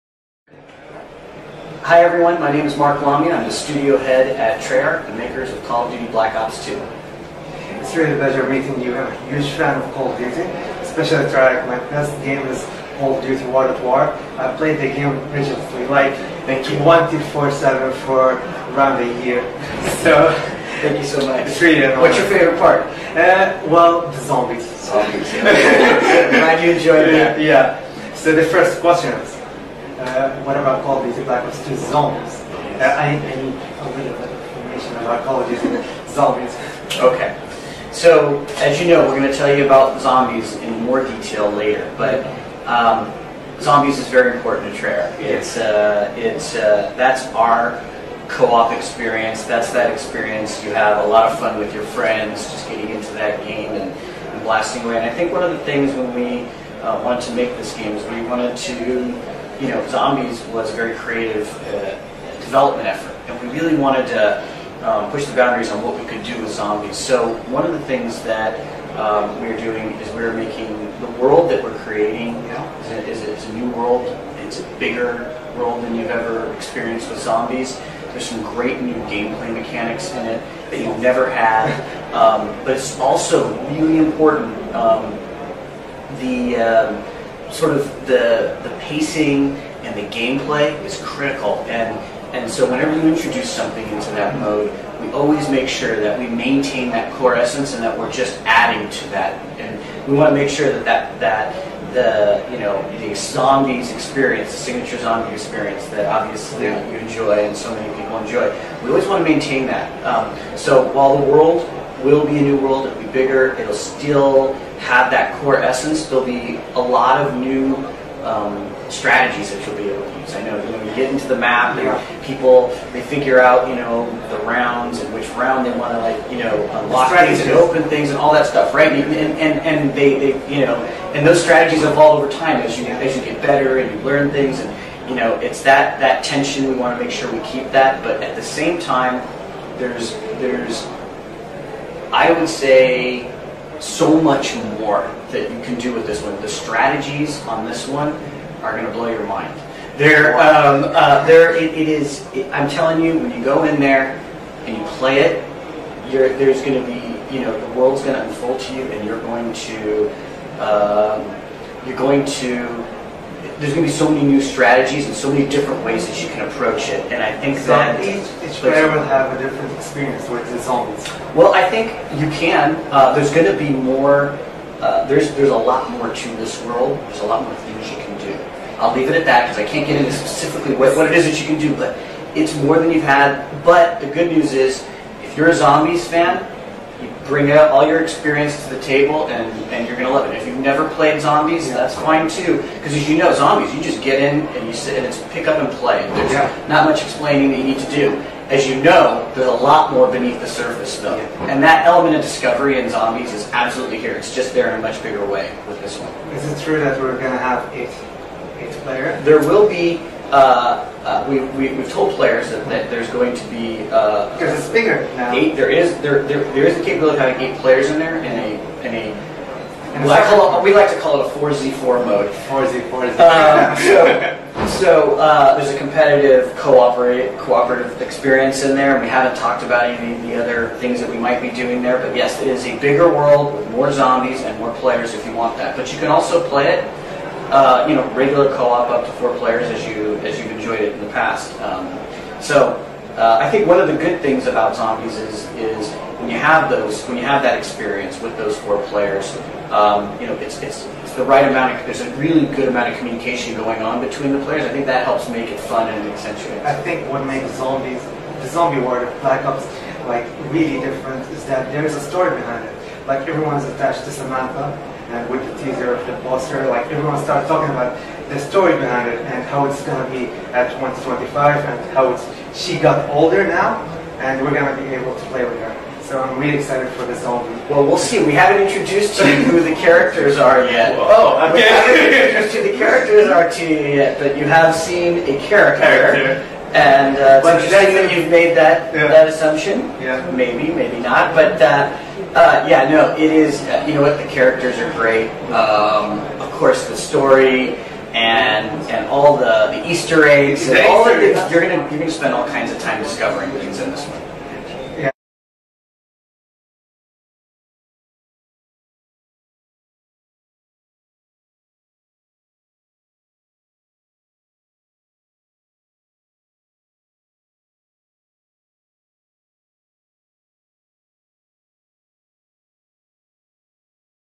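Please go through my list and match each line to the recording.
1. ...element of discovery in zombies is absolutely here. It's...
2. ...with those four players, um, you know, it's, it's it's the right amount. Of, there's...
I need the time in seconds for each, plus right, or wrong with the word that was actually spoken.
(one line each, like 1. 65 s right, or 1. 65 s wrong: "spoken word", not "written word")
1. 201 s right
2. 248 s right.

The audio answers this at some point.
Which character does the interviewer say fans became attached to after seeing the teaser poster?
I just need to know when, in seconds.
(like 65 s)
264 s.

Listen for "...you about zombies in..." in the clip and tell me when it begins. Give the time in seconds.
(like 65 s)
39 s.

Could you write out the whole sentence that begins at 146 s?
The strategies on this one are going to blow your mind.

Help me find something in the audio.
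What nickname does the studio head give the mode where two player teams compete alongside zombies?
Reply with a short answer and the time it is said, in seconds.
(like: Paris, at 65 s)
4Z4, at 221 s.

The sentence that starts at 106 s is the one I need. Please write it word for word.
you enjoy and so many people enjoy.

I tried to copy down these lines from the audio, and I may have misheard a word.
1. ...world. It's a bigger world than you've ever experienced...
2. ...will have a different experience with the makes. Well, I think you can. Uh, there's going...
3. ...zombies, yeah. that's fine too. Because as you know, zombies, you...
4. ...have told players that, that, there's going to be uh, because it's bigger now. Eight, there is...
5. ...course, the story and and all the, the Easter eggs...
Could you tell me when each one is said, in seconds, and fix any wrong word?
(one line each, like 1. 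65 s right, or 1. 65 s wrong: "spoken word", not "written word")
1. 73 s right
2. 168 s wrong: "zombies", not "makes"
3. 191 s right
4. 211 s right
5. 296 s right.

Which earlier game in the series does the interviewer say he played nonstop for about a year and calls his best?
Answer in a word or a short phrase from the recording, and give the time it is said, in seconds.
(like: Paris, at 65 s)
Call of Duty World at War, at 12 s.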